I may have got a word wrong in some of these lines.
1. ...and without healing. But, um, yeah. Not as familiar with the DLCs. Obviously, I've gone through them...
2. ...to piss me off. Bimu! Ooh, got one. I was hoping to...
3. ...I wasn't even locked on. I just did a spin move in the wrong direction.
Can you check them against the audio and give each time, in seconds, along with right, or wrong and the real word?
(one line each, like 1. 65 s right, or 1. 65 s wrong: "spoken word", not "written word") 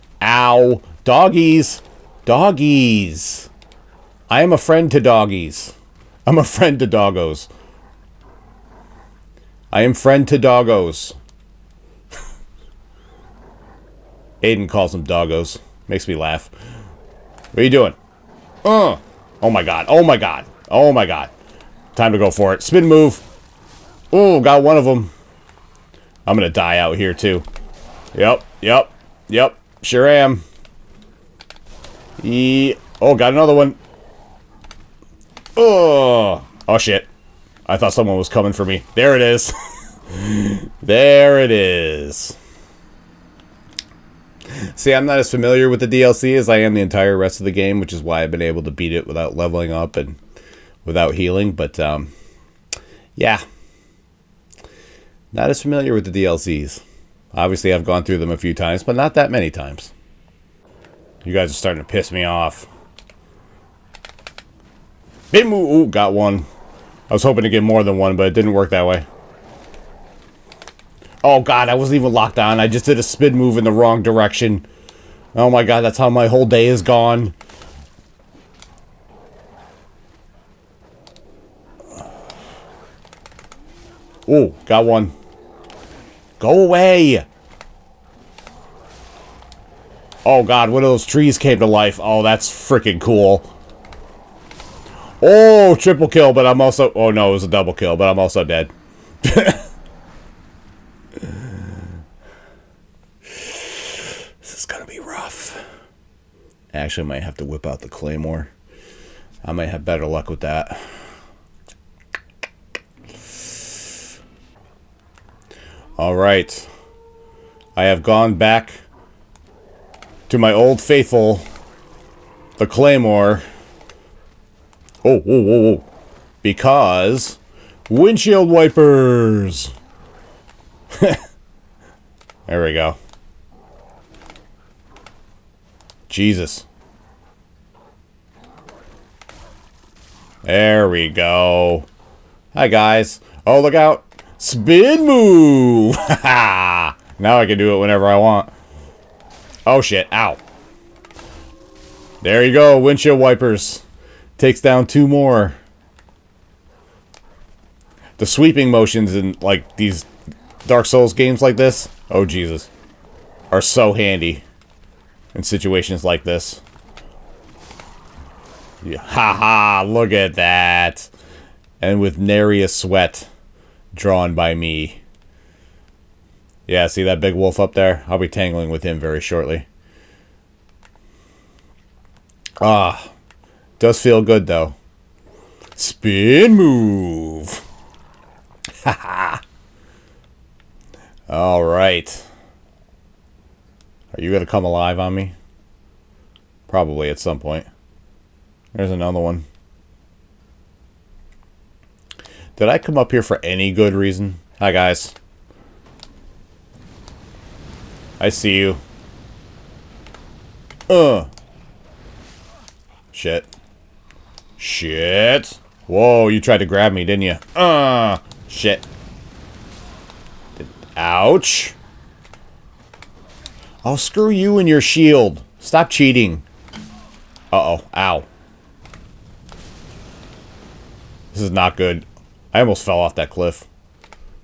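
1. 49 s right
2. 61 s right
3. 71 s right.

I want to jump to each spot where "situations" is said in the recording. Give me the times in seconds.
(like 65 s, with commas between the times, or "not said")
165 s.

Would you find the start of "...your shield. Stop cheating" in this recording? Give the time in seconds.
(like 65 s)
224 s.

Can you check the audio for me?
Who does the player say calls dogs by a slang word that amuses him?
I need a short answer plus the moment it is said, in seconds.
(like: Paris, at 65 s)
Aiden, at 14 s.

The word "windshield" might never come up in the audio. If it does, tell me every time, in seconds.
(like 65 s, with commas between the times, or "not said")
127 s, 152 s.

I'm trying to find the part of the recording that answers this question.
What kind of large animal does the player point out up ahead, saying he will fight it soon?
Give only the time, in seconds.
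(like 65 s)
177 s.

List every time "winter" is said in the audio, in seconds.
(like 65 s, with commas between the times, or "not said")
not said.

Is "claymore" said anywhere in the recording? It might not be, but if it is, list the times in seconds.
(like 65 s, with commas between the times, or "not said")
107 s, 122 s.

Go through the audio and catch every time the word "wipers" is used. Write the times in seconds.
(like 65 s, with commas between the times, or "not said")
128 s, 153 s.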